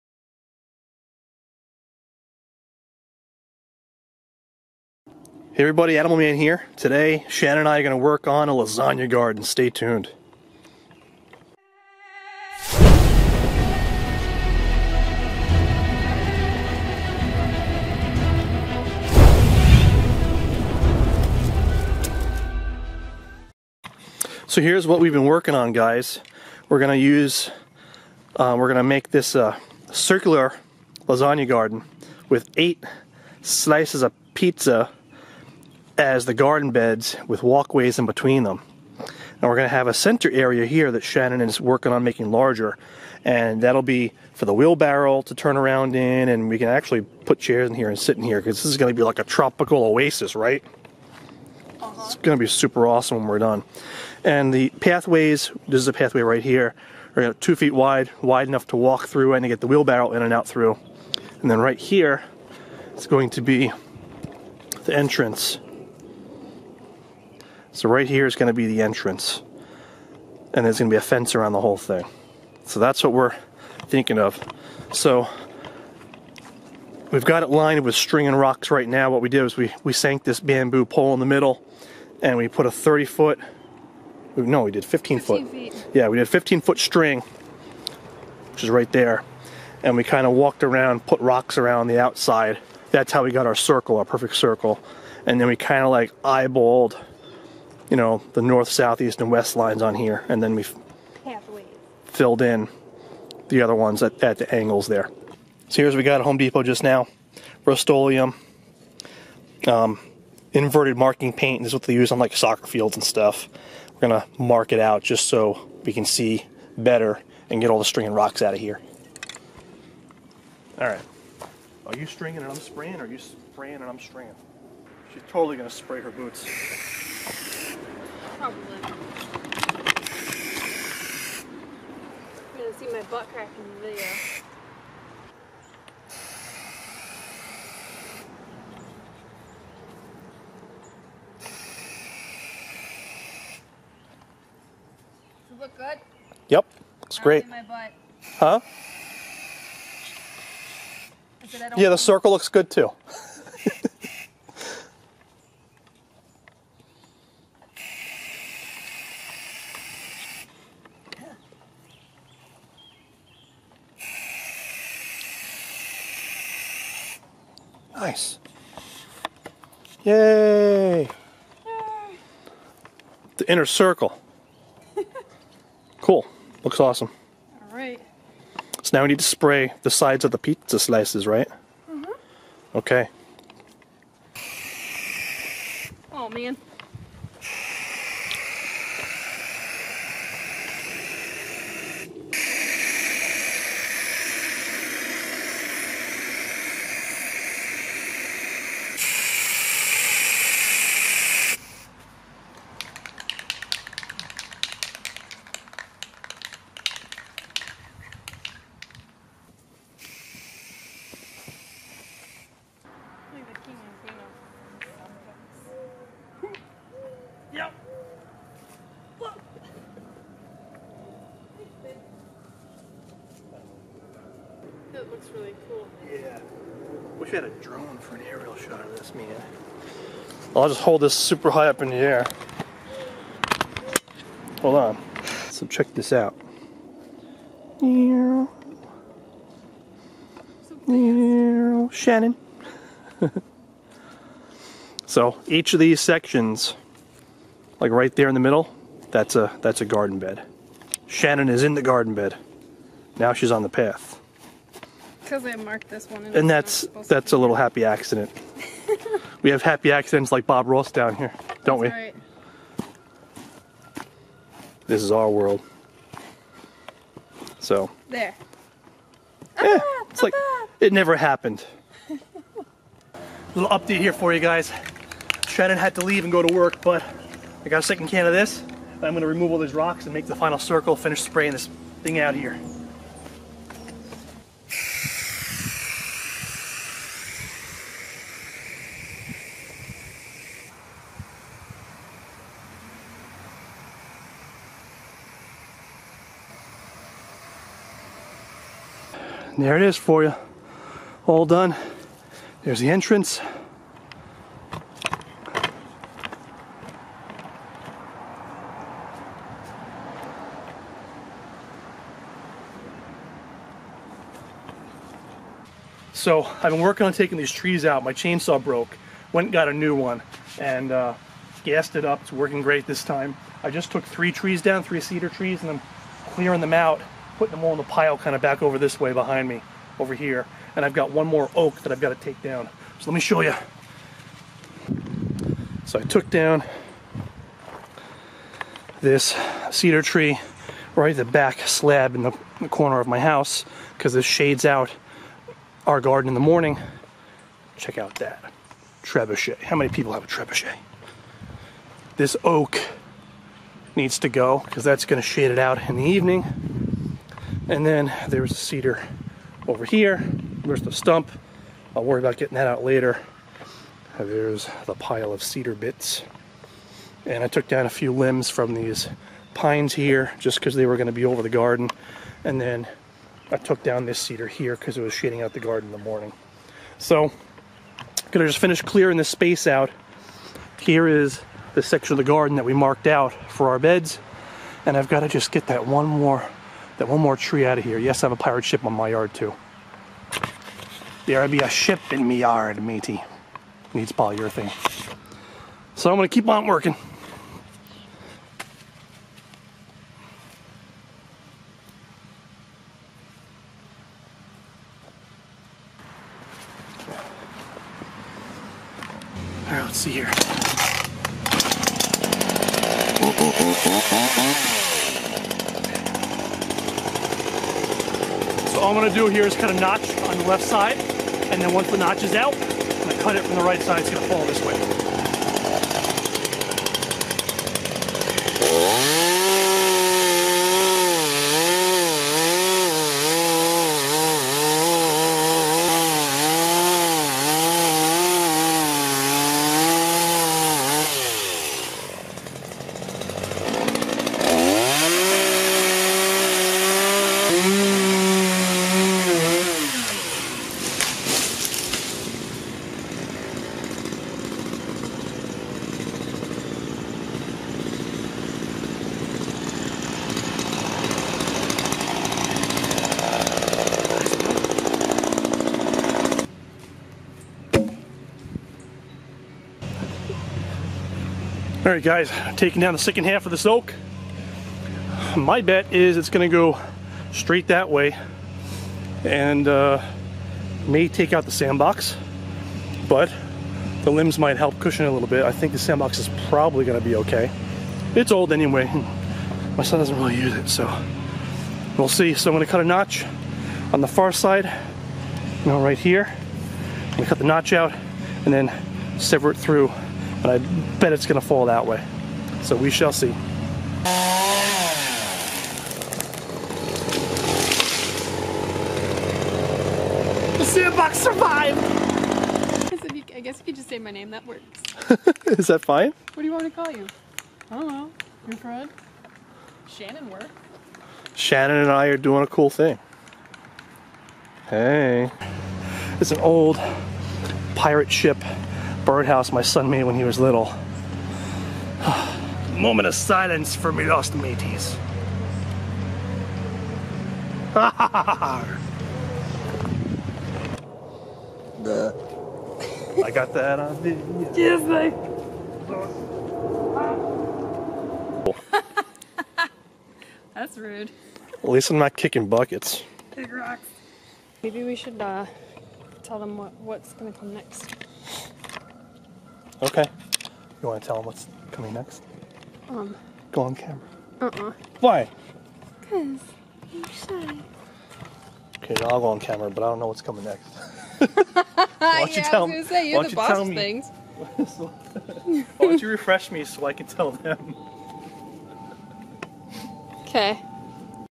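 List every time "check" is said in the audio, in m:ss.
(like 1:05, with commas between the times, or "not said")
3:55, 5:47.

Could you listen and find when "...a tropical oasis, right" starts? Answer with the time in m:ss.
0:49.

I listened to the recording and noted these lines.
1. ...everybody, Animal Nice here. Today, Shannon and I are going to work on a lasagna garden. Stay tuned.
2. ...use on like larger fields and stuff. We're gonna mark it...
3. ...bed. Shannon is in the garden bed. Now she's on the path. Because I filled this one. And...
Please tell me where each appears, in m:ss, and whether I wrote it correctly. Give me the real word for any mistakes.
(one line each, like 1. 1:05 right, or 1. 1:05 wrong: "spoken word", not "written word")
1. 0:05 wrong: "Man", not "Nice"
2. 1:51 wrong: "soccer", not "larger"
3. 4:10 wrong: "marked", not "filled".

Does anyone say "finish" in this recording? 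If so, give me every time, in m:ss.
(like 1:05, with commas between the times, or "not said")
4:40, 6:18.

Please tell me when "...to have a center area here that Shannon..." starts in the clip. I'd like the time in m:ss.
0:39.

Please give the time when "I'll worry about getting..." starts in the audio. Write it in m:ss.
6:01.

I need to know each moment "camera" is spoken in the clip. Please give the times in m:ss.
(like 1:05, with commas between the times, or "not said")
9:23, 9:29.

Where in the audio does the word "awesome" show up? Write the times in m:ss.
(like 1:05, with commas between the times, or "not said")
0:52, 2:56.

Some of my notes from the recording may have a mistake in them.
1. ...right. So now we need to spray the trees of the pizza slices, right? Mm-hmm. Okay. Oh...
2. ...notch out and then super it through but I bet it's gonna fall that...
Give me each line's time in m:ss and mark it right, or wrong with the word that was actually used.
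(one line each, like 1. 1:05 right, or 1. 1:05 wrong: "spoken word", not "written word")
1. 2:57 wrong: "sides", not "trees"
2. 8:17 wrong: "sever", not "super".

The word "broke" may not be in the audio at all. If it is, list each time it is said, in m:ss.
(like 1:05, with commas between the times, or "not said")
5:18.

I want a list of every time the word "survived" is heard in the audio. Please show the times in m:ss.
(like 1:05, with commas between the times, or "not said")
8:31.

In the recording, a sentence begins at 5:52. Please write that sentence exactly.
This oak needs to go because that's going to shade it out in the evening.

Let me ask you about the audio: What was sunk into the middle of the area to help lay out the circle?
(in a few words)
Bamboo pole.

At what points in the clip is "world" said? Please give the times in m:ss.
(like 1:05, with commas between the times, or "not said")
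4:25.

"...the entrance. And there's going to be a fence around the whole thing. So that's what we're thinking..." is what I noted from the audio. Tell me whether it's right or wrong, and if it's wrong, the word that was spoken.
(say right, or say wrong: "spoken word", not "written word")
right.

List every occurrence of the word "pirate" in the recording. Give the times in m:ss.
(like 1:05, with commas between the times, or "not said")
6:28, 8:47.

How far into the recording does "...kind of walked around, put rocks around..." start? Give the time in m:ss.
1:30.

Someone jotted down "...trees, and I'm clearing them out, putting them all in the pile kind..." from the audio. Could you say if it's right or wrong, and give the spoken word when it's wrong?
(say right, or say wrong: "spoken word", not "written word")
right.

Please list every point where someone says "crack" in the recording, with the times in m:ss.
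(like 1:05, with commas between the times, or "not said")
2:13.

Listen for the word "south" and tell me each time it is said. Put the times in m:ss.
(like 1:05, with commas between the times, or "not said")
1:38.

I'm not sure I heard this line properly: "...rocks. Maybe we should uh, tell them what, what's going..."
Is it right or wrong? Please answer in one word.
right.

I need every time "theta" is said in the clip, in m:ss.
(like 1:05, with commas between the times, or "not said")
not said.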